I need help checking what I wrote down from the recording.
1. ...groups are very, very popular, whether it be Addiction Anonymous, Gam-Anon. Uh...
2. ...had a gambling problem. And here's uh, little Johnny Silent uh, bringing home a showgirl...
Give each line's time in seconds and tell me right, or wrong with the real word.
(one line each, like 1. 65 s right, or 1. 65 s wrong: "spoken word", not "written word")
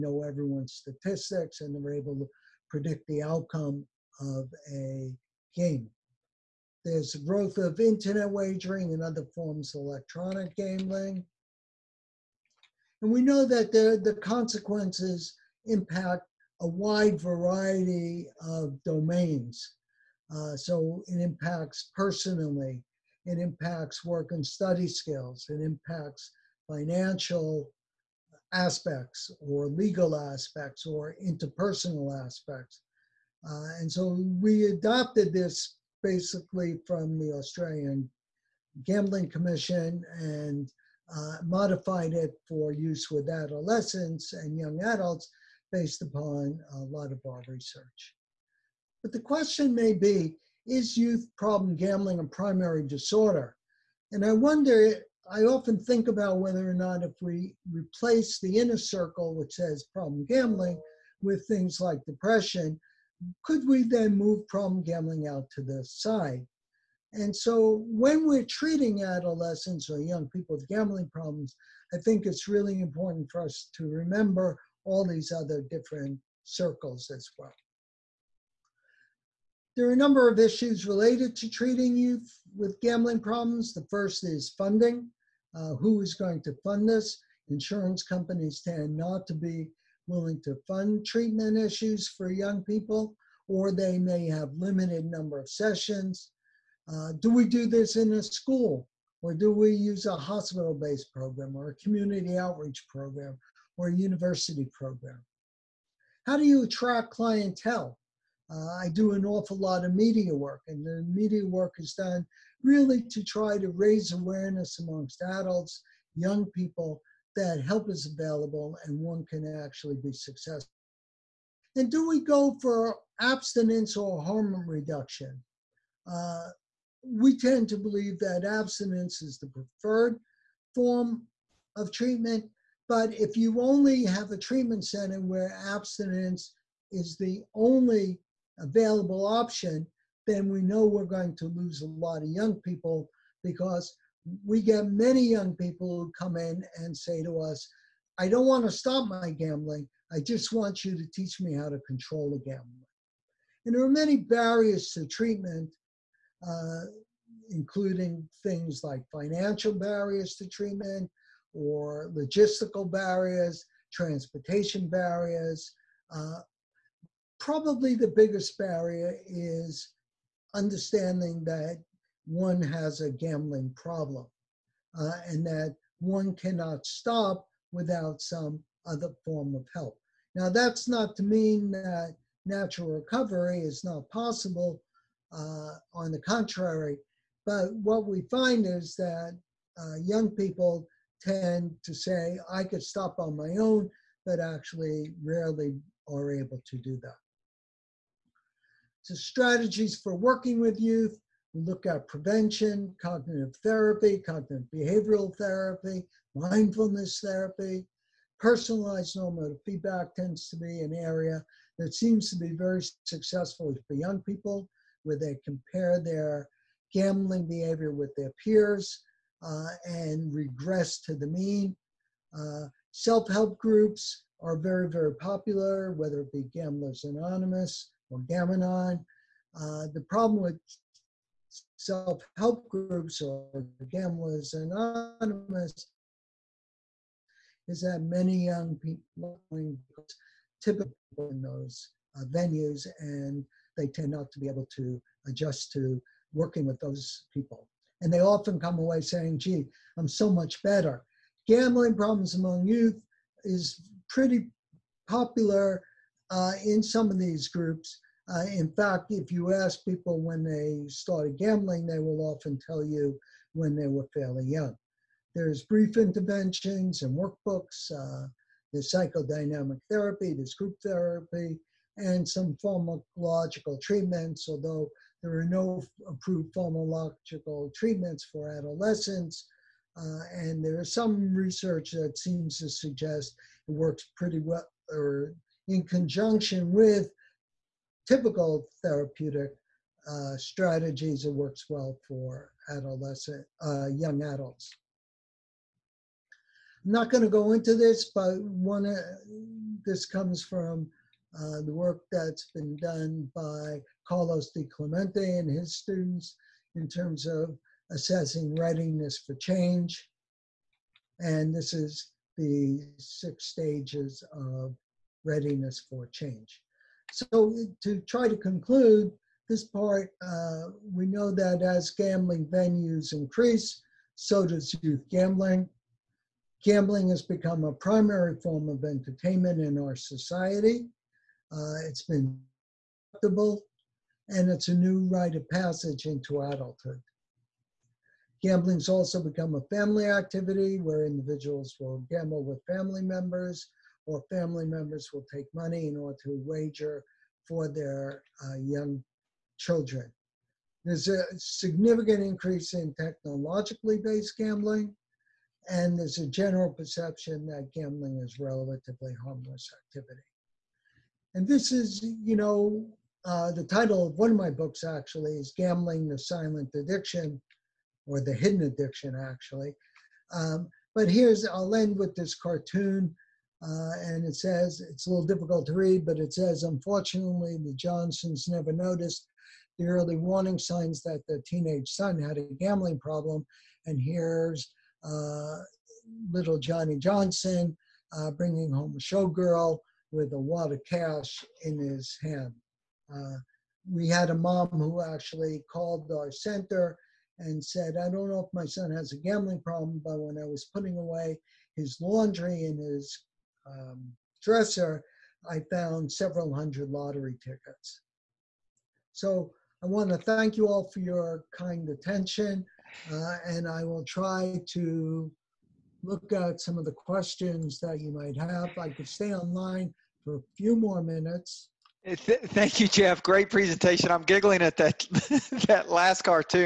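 1. 223 s wrong: "Gamblers", not "Addiction"
2. 382 s wrong: "Johnson", not "Silent".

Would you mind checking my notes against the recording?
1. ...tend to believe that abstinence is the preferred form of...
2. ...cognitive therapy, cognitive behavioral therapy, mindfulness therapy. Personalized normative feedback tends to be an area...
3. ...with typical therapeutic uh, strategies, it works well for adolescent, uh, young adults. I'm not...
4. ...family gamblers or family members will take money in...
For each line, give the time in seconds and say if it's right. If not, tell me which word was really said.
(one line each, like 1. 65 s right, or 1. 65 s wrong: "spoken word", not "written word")
1. 127 s right
2. 203 s right
3. 286 s right
4. 342 s wrong: "members", not "gamblers".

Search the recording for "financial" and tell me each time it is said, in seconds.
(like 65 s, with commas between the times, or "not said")
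26 s, 159 s.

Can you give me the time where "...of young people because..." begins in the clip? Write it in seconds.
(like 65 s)
142 s.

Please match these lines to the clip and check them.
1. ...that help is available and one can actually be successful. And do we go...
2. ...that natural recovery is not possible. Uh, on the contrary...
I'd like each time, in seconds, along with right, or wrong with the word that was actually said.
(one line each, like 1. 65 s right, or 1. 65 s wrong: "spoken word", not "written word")
1. 117 s right
2. 181 s right.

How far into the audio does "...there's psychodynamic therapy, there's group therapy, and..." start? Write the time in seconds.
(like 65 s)
268 s.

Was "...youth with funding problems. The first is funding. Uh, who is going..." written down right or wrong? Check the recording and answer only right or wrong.
wrong.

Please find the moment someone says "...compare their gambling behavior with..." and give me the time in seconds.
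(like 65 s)
215 s.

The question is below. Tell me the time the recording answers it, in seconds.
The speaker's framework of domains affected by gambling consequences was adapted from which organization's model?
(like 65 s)
37 s.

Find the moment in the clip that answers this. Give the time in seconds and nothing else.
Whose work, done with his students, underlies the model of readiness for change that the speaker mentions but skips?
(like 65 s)
304 s.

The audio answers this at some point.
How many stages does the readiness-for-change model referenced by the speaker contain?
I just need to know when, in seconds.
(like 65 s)
312 s.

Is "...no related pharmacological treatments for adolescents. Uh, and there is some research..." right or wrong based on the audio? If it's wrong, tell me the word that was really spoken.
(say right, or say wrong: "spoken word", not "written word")
wrong: "approved", not "related".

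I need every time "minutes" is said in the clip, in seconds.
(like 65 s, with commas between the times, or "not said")
421 s.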